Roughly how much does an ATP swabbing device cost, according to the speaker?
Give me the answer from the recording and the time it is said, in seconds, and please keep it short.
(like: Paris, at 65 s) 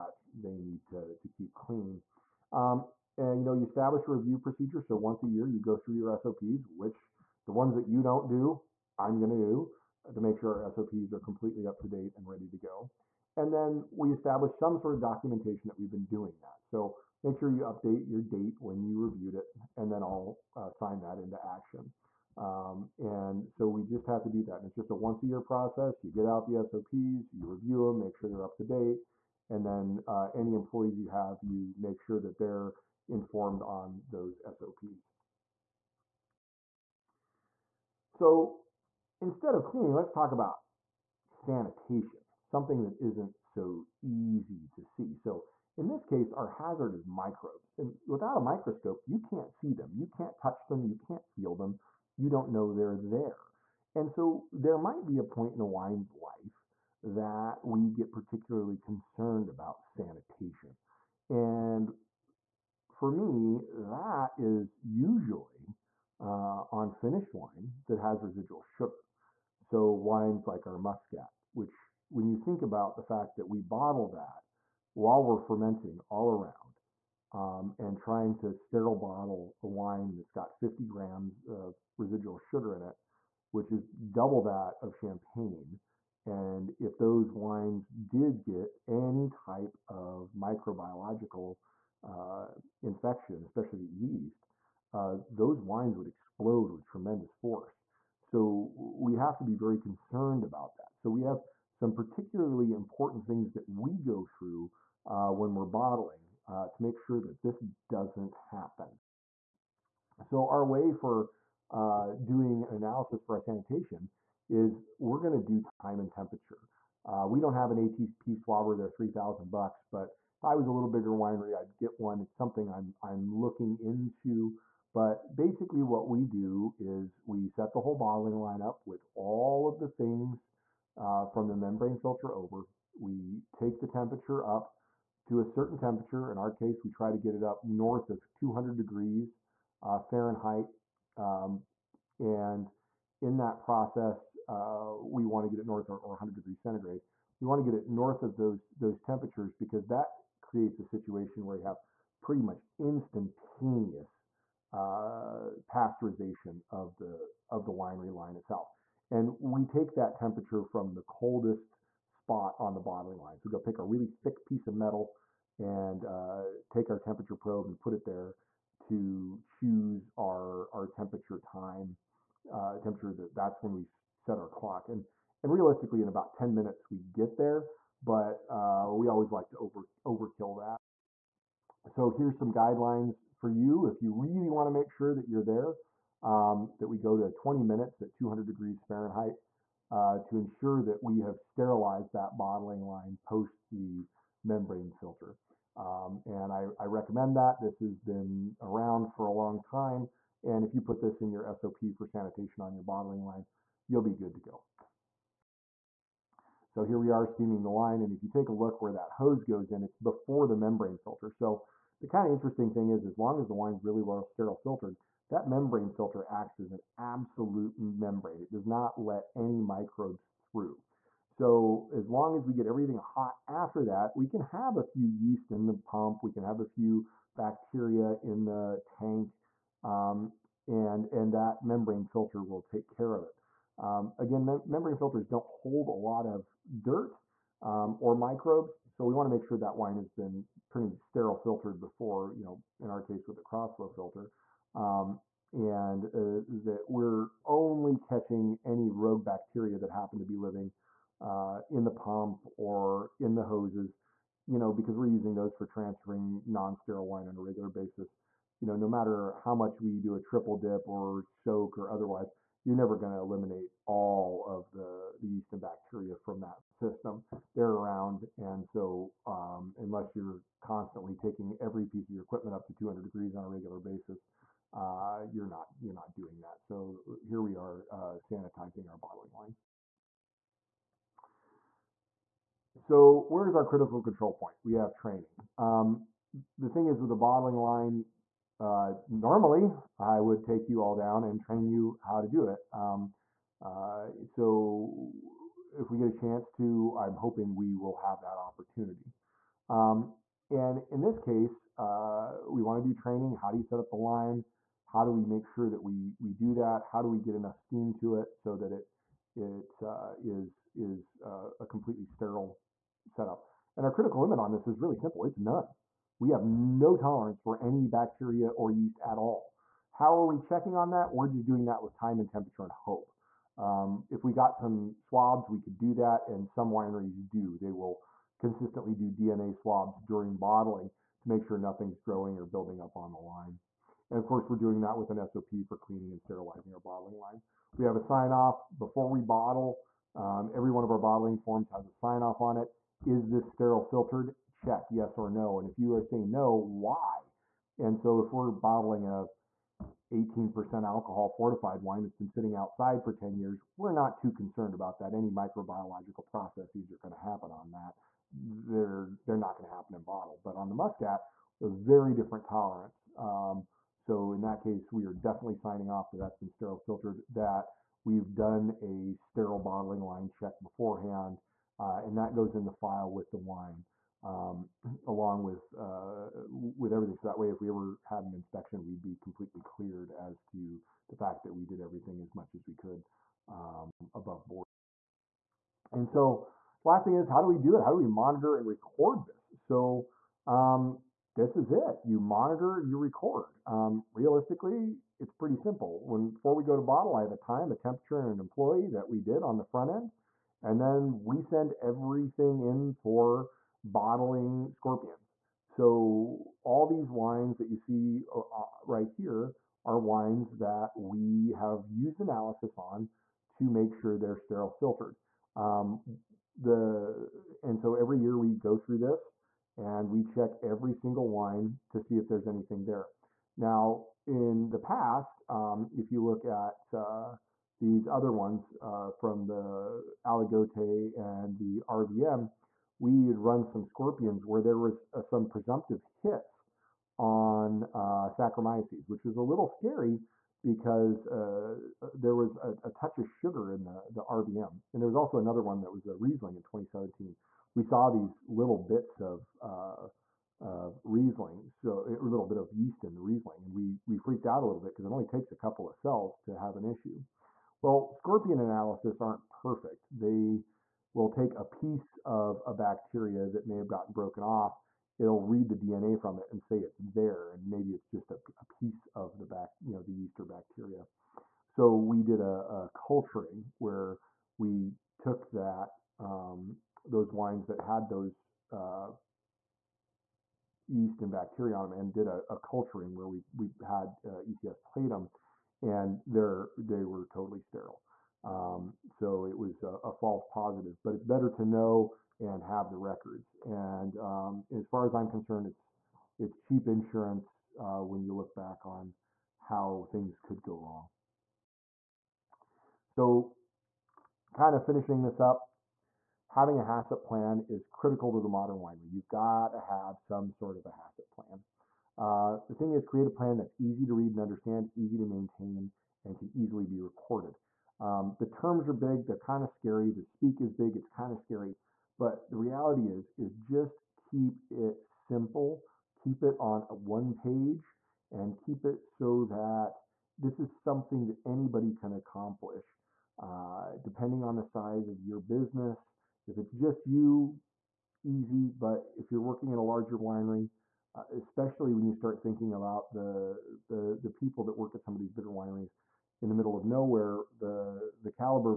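$3,000, at 118 s.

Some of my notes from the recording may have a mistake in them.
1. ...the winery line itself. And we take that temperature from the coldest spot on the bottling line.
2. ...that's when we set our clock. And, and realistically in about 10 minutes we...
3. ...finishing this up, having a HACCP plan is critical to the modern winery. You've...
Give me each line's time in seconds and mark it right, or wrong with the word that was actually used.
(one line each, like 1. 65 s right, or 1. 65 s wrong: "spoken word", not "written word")
1. 157 s right
2. 173 s right
3. 504 s right.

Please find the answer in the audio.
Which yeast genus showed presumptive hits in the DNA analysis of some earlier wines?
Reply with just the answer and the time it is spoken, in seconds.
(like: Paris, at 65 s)
Saccharomyces, at 438 s.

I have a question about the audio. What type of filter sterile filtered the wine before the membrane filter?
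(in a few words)
Cross-flow filter.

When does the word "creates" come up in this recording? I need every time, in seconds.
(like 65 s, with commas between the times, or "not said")
150 s, 513 s.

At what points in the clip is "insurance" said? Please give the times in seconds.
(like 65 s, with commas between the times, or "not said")
496 s.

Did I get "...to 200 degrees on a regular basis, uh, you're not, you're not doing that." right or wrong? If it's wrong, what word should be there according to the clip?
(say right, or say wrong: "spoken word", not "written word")
right.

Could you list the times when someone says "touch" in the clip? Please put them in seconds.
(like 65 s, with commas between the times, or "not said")
50 s, 442 s.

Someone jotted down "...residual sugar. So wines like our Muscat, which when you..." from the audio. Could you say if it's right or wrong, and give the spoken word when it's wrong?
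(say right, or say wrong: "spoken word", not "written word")
right.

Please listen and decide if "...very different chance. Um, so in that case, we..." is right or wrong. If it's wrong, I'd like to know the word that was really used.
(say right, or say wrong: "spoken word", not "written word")
wrong: "tolerance", not "chance".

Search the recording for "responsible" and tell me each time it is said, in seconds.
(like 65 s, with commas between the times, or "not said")
not said.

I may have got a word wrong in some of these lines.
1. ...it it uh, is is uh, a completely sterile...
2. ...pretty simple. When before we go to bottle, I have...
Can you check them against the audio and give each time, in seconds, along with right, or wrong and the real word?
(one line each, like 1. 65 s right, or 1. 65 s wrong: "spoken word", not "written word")
1. 308 s right
2. 395 s right.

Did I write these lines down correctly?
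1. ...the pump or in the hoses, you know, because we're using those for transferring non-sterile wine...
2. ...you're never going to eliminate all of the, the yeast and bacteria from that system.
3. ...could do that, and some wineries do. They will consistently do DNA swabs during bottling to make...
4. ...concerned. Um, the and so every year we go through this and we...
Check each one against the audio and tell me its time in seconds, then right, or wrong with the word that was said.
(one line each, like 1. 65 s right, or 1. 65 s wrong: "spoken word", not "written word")
1. 251 s right
2. 262 s right
3. 325 s right
4. 414 s wrong: "filtered", not "concerned".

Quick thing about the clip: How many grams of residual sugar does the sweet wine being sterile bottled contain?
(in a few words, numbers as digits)
50.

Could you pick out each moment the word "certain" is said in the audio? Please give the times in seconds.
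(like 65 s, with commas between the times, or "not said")
135 s.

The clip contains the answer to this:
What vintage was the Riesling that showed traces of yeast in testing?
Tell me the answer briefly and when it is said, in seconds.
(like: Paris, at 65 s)
2017, at 446 s.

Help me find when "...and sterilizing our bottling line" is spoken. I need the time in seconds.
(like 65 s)
336 s.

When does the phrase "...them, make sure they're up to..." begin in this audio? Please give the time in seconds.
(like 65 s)
27 s.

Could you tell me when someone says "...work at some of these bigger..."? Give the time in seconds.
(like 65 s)
544 s.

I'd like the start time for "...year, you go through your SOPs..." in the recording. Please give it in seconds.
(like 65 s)
5 s.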